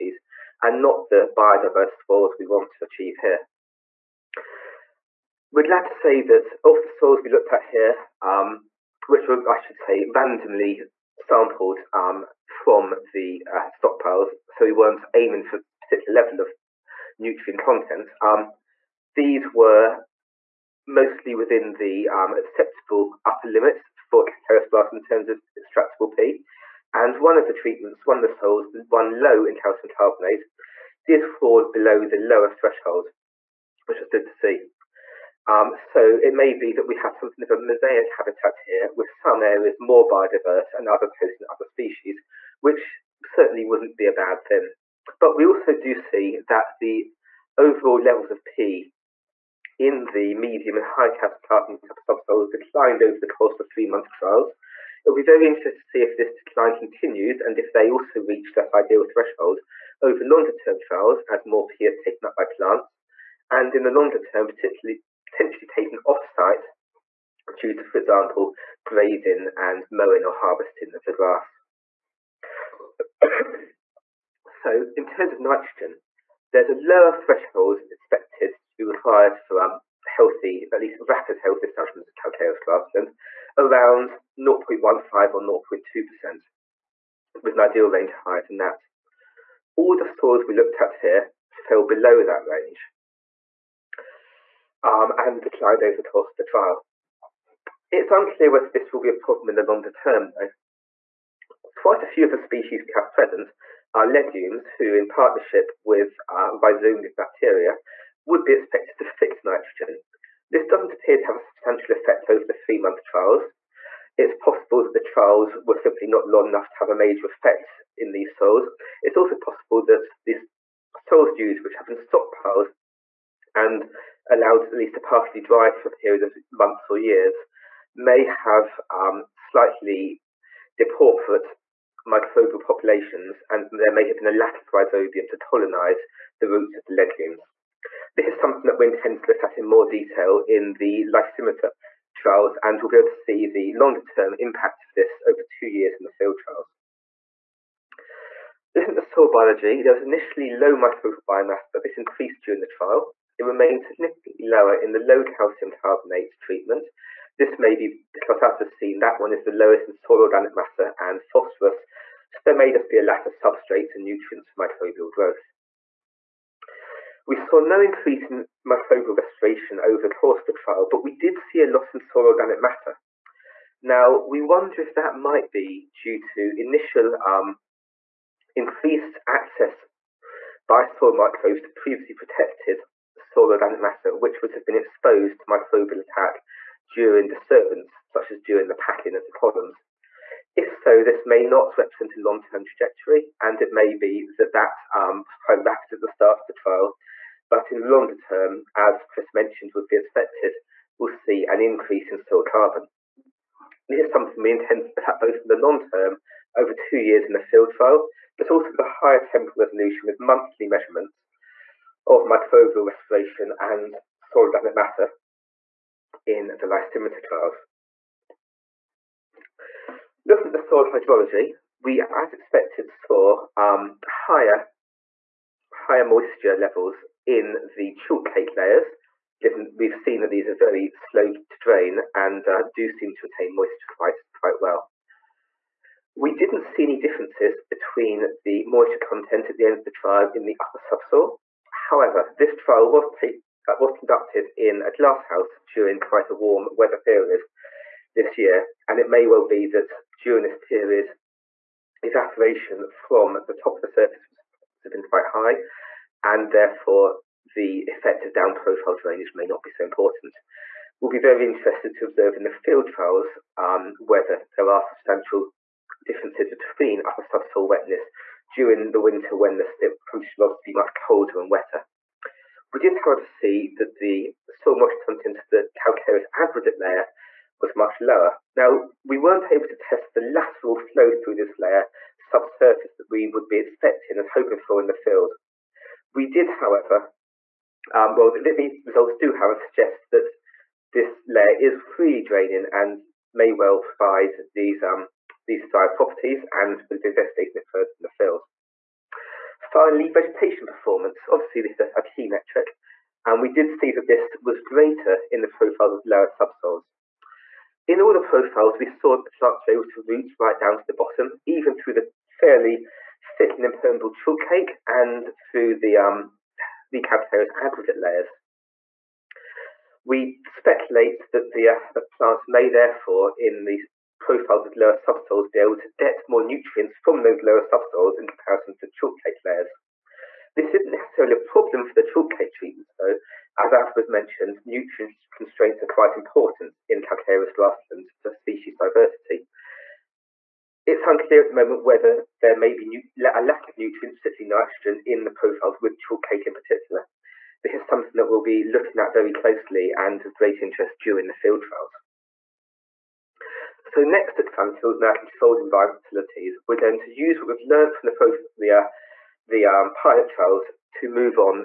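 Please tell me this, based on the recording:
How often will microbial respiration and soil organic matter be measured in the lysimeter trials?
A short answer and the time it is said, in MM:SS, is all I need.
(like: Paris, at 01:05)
monthly, at 03:30.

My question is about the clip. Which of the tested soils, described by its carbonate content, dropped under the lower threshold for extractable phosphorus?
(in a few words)
low calcium carbonate.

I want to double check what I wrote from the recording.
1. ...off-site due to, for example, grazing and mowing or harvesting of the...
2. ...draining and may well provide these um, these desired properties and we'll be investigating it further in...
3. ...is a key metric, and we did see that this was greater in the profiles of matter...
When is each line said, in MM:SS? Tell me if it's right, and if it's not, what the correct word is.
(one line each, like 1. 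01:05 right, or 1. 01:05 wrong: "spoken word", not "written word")
1. 01:06 right
2. 04:52 right
3. 05:01 wrong: "lower", not "matter".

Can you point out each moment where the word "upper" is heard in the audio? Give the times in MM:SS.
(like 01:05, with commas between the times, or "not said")
00:23, 04:00, 04:27.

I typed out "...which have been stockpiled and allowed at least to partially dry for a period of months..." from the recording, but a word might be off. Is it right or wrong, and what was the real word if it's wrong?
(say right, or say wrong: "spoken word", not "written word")
right.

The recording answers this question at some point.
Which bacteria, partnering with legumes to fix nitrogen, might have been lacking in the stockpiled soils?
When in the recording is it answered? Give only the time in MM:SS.
02:14.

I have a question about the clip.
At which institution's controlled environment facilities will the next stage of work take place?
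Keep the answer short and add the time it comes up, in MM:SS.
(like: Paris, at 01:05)
Cranfield, at 05:54.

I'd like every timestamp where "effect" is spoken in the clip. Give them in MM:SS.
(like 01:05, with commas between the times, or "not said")
01:51, 01:57, 04:17.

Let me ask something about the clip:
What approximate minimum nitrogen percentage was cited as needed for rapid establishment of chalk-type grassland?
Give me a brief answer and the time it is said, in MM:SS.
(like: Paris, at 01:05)
0.15 or 0.2%, at 01:24.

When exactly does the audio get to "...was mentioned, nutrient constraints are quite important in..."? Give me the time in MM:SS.
05:33.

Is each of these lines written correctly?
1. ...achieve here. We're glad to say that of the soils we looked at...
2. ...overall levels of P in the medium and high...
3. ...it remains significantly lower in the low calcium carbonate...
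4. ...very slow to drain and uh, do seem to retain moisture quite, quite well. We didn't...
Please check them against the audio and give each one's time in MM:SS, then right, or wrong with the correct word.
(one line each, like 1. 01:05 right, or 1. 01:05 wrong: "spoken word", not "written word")
1. 00:02 right
2. 00:47 right
3. 02:33 right
4. 03:50 right.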